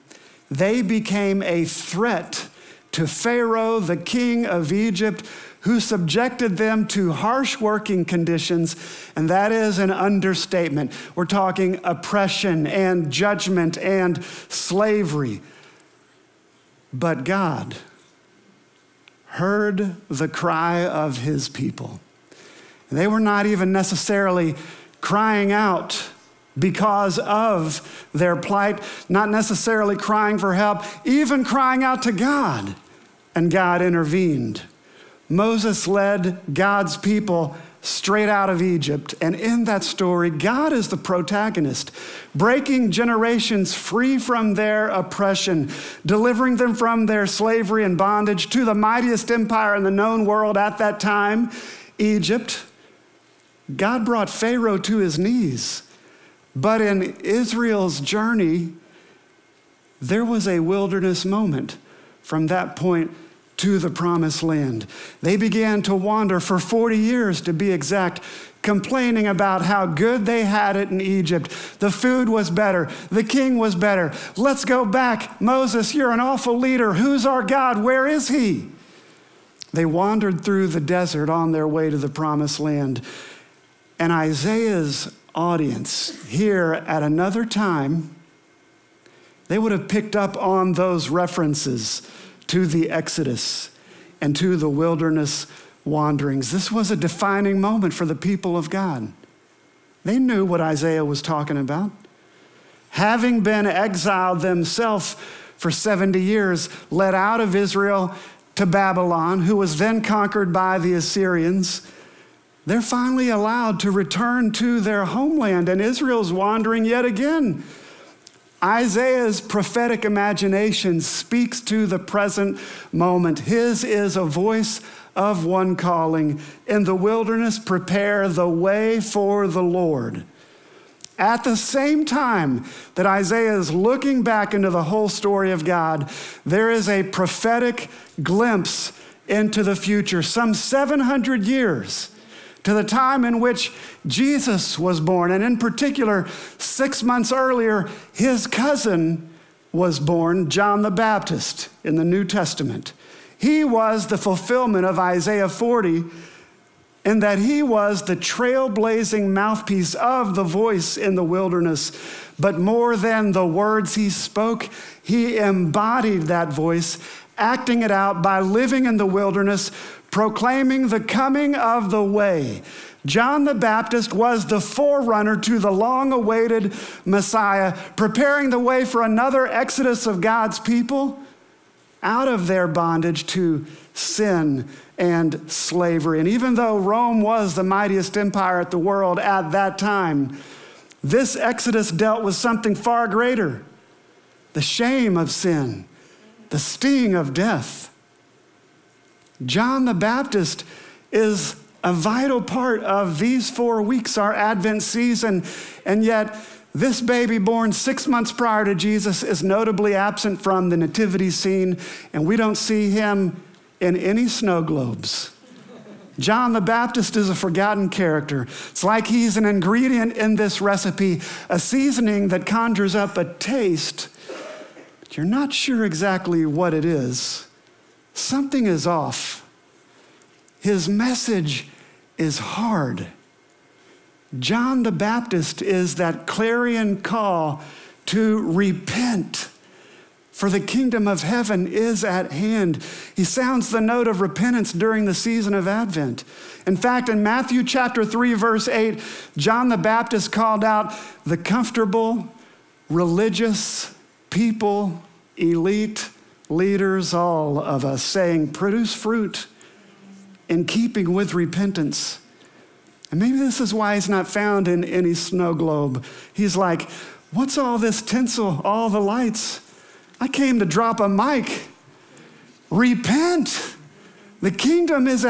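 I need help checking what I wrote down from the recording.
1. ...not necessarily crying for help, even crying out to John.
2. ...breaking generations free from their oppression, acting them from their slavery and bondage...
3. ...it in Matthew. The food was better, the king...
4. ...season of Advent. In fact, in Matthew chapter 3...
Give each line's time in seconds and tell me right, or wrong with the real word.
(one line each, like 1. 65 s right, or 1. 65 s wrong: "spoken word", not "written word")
1. 29 s wrong: "God", not "John"
2. 42 s wrong: "delivering", not "acting"
3. 70 s wrong: "Egypt", not "Matthew"
4. 245 s right.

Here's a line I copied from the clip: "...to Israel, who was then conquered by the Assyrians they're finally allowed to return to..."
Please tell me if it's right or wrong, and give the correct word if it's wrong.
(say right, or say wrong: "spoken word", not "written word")
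wrong: "Babylon", not "Israel".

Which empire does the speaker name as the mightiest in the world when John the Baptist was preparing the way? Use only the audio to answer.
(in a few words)
Rome.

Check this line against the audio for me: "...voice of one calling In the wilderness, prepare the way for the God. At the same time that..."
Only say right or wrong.
wrong.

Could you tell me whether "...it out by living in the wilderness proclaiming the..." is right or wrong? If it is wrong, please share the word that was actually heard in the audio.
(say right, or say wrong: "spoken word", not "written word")
right.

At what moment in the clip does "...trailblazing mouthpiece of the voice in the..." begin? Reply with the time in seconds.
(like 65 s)
158 s.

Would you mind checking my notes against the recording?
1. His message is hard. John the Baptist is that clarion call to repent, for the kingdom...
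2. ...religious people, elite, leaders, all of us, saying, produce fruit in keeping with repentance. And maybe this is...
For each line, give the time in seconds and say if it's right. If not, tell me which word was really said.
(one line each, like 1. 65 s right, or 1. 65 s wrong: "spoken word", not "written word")
1. 230 s right
2. 252 s right.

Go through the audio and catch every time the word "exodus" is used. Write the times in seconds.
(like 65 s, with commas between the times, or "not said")
92 s, 179 s, 191 s.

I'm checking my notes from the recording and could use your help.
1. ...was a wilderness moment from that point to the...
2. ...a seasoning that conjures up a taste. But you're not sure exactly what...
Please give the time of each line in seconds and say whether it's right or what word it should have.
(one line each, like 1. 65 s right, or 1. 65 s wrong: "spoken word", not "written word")
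1. 60 s right
2. 221 s right.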